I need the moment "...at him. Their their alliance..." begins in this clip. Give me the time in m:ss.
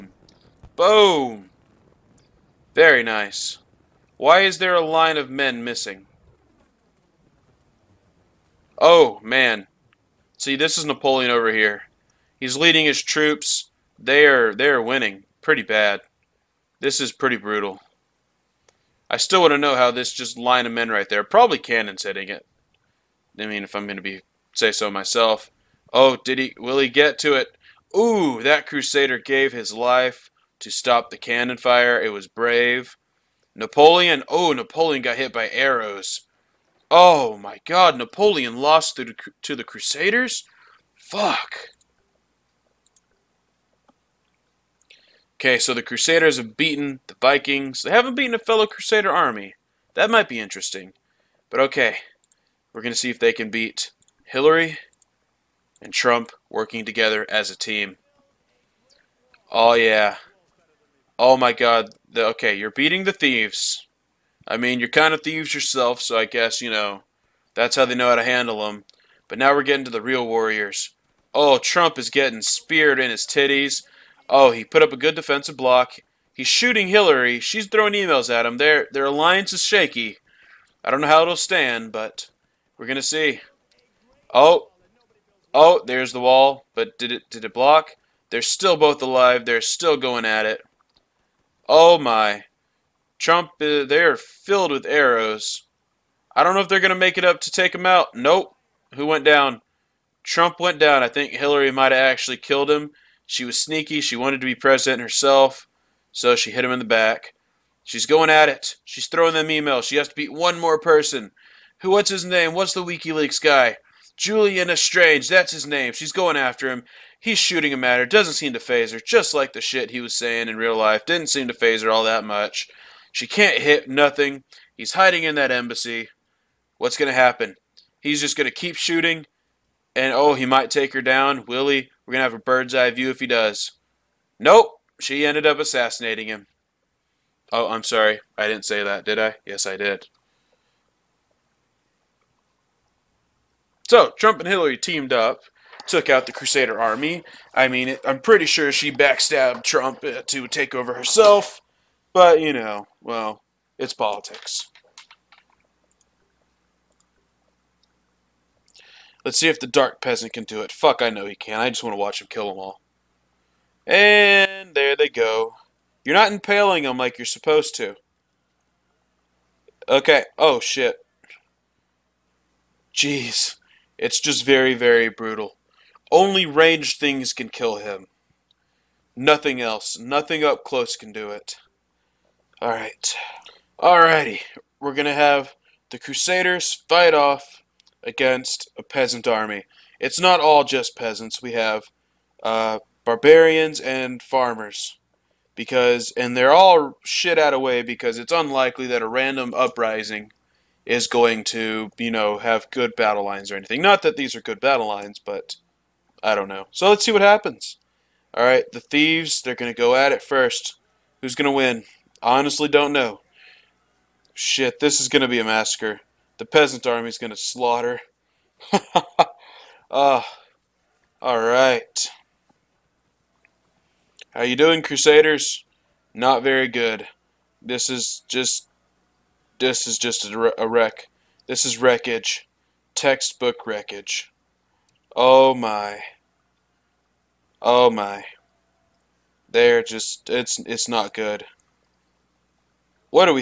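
1:18.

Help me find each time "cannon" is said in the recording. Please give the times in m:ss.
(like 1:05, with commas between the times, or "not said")
0:21, 0:31.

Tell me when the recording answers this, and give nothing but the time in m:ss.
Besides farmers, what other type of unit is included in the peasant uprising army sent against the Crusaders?
3:13.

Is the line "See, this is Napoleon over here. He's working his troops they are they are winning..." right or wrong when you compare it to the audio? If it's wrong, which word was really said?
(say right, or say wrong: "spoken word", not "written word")
wrong: "leading", not "working".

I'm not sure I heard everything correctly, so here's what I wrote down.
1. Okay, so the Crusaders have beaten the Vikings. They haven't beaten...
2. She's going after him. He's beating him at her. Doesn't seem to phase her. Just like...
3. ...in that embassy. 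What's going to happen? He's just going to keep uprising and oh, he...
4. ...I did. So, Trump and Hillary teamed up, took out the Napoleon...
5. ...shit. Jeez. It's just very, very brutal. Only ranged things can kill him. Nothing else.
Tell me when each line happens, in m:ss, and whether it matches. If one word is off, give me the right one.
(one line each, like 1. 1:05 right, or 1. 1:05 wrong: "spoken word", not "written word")
1. 0:45 right
2. 1:55 wrong: "shooting", not "beating"
3. 2:05 wrong: "shooting", not "uprising"
4. 2:19 wrong: "Crusader", not "Napoleon"
5. 2:50 right.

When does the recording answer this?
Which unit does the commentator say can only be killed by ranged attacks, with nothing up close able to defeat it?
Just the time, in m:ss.
2:39.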